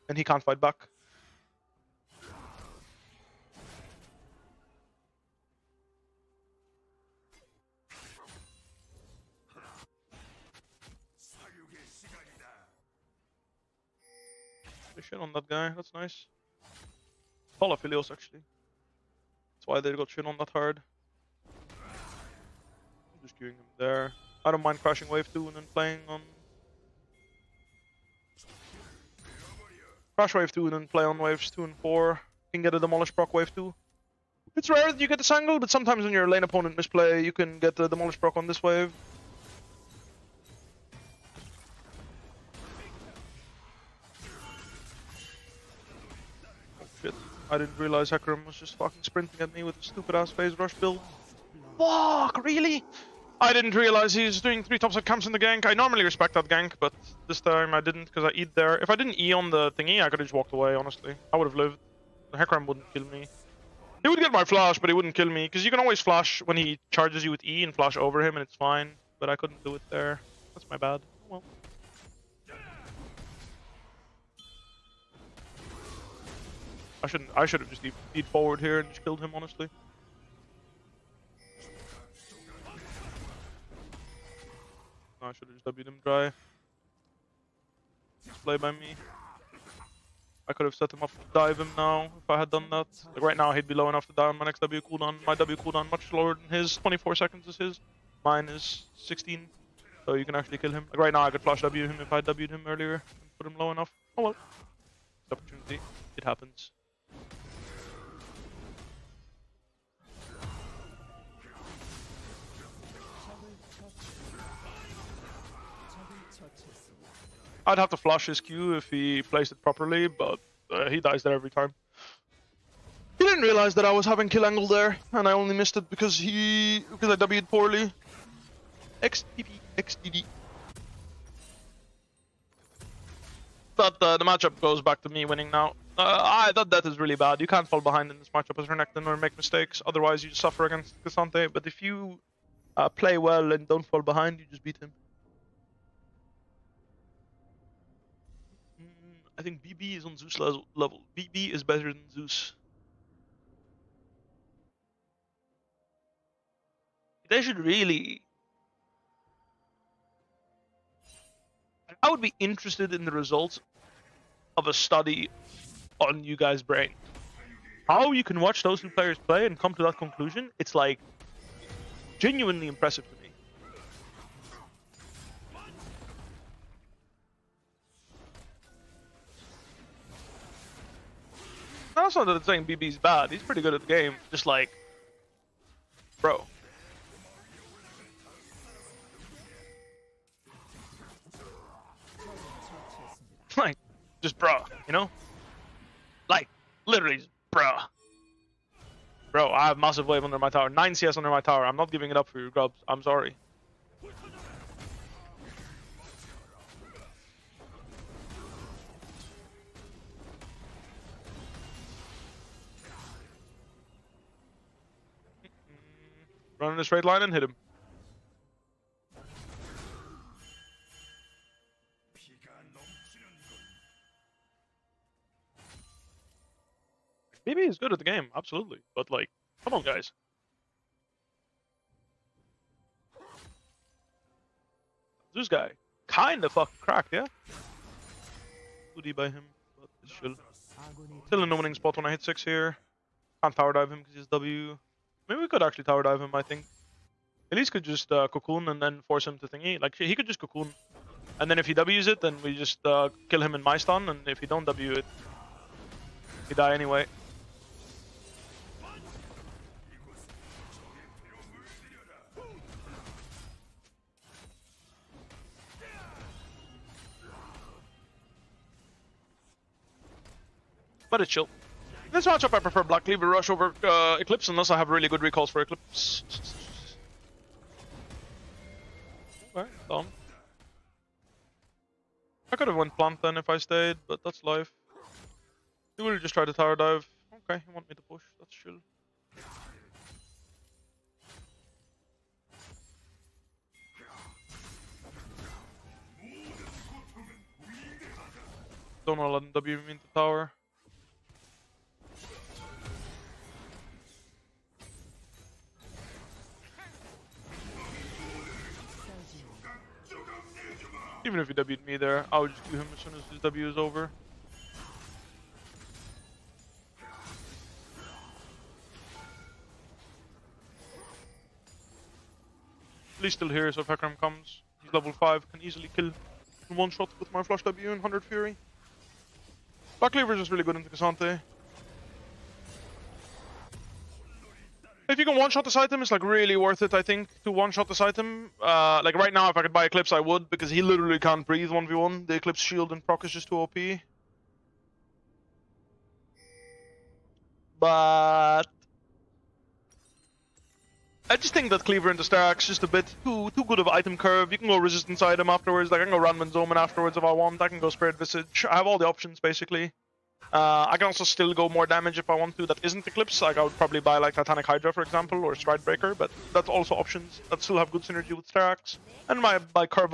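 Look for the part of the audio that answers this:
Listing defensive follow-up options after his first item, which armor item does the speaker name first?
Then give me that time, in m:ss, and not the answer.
5:56.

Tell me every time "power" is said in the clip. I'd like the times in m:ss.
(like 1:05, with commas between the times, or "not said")
4:03.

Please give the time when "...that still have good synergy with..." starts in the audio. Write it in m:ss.
6:07.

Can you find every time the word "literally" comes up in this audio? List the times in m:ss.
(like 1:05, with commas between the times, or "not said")
3:16, 5:40.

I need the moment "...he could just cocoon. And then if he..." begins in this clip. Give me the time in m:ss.
4:09.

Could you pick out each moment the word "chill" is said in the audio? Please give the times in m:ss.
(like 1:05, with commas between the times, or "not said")
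4:00, 4:31, 4:48.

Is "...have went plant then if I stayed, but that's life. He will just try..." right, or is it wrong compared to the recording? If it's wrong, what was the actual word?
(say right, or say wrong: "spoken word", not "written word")
right.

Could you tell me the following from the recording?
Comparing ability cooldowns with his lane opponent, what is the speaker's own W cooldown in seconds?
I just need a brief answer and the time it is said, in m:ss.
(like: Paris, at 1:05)
16, at 1:38.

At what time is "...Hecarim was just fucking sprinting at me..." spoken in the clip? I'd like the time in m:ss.
0:48.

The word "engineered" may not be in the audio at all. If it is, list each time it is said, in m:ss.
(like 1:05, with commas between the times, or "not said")
not said.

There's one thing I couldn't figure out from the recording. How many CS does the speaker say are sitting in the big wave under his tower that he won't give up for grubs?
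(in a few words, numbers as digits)
9.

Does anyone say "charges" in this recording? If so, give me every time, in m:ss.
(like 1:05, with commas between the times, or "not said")
1:06.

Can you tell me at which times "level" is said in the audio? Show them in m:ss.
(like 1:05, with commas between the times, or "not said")
2:30, 5:24.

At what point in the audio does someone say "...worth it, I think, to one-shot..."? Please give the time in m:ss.
5:36.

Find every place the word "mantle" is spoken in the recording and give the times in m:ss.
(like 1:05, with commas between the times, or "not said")
not said.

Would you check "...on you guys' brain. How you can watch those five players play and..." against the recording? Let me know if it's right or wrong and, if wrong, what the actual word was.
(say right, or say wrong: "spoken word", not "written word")
wrong: "two", not "five".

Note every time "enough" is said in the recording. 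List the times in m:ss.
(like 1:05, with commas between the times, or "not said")
1:33, 1:43.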